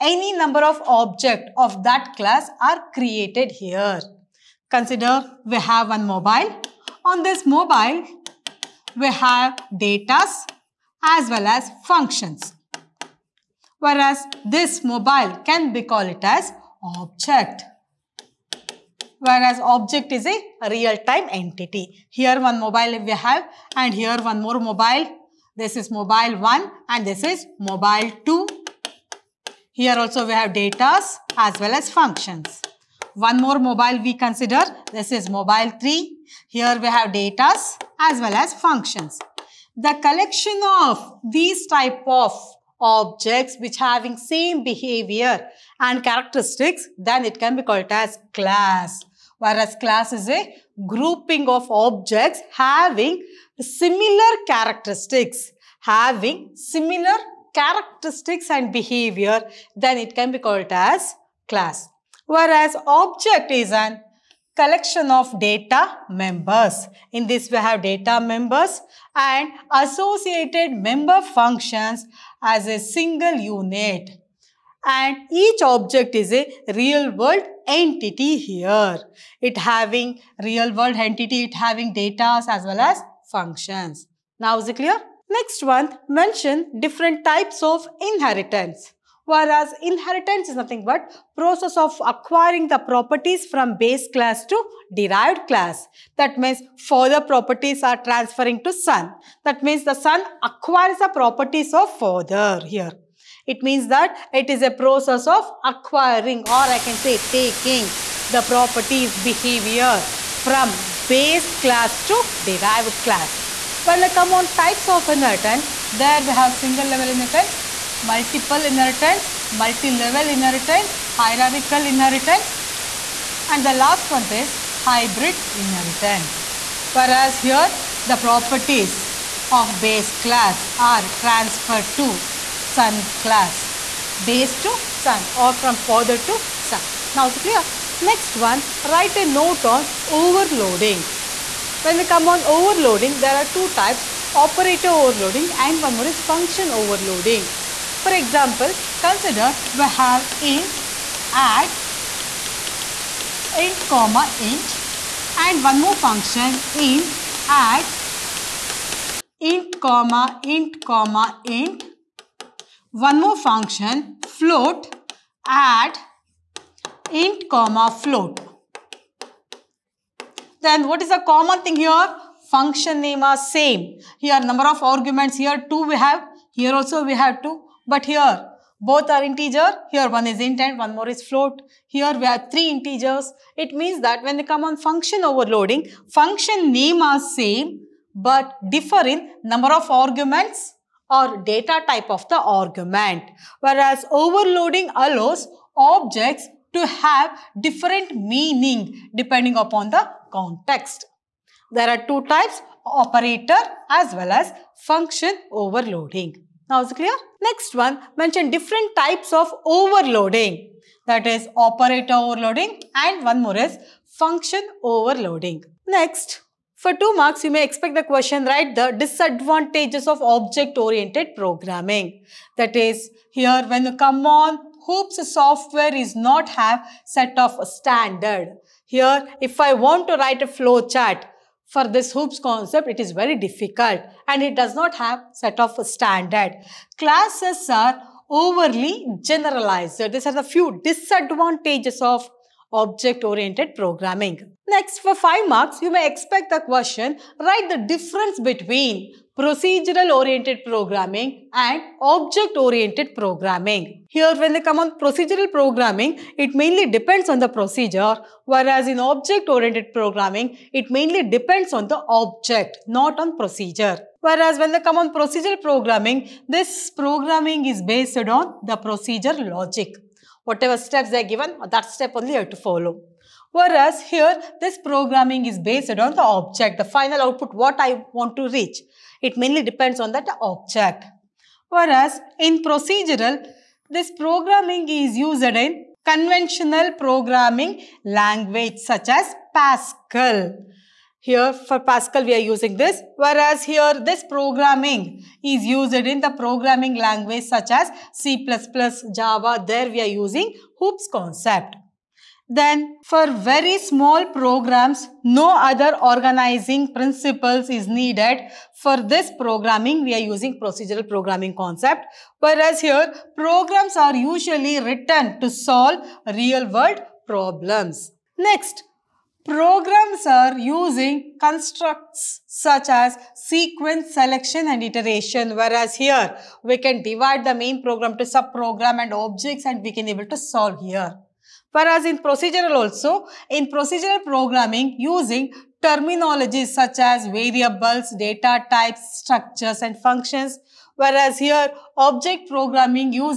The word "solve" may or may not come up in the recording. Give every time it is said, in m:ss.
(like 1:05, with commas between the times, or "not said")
5:15, 5:30.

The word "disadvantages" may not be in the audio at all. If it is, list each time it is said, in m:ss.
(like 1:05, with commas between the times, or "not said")
3:38, 4:00.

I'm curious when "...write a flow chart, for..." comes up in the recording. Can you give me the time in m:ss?
3:50.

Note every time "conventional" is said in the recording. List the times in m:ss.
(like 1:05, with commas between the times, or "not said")
4:46.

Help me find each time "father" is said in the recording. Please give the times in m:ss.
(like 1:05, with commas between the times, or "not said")
1:36, 1:41, 2:15.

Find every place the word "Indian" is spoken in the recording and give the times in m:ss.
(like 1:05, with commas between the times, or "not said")
not said.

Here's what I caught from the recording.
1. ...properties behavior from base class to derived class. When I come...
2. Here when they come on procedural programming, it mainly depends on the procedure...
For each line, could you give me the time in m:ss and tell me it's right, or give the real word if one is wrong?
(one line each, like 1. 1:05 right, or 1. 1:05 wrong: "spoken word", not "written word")
1. 1:48 right
2. 4:14 right.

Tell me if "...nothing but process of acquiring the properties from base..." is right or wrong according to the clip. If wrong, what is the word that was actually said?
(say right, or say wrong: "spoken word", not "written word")
right.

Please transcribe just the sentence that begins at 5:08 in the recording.
For this programming, we are using procedural programming concept.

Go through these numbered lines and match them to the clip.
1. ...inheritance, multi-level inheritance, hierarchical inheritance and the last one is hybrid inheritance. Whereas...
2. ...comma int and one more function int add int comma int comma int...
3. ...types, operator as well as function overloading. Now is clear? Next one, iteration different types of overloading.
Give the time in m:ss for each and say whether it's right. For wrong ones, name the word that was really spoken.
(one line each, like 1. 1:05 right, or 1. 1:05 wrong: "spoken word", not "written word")
1. 1:58 right
2. 2:33 right
3. 3:22 wrong: "mention", not "iteration".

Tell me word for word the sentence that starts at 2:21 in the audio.
When we come on overloading, there are two types, operator overloading and one more is function overloading.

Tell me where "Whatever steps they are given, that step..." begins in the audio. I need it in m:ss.
4:30.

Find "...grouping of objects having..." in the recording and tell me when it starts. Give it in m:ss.
0:50.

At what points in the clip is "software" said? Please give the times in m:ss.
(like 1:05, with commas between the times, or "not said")
3:45.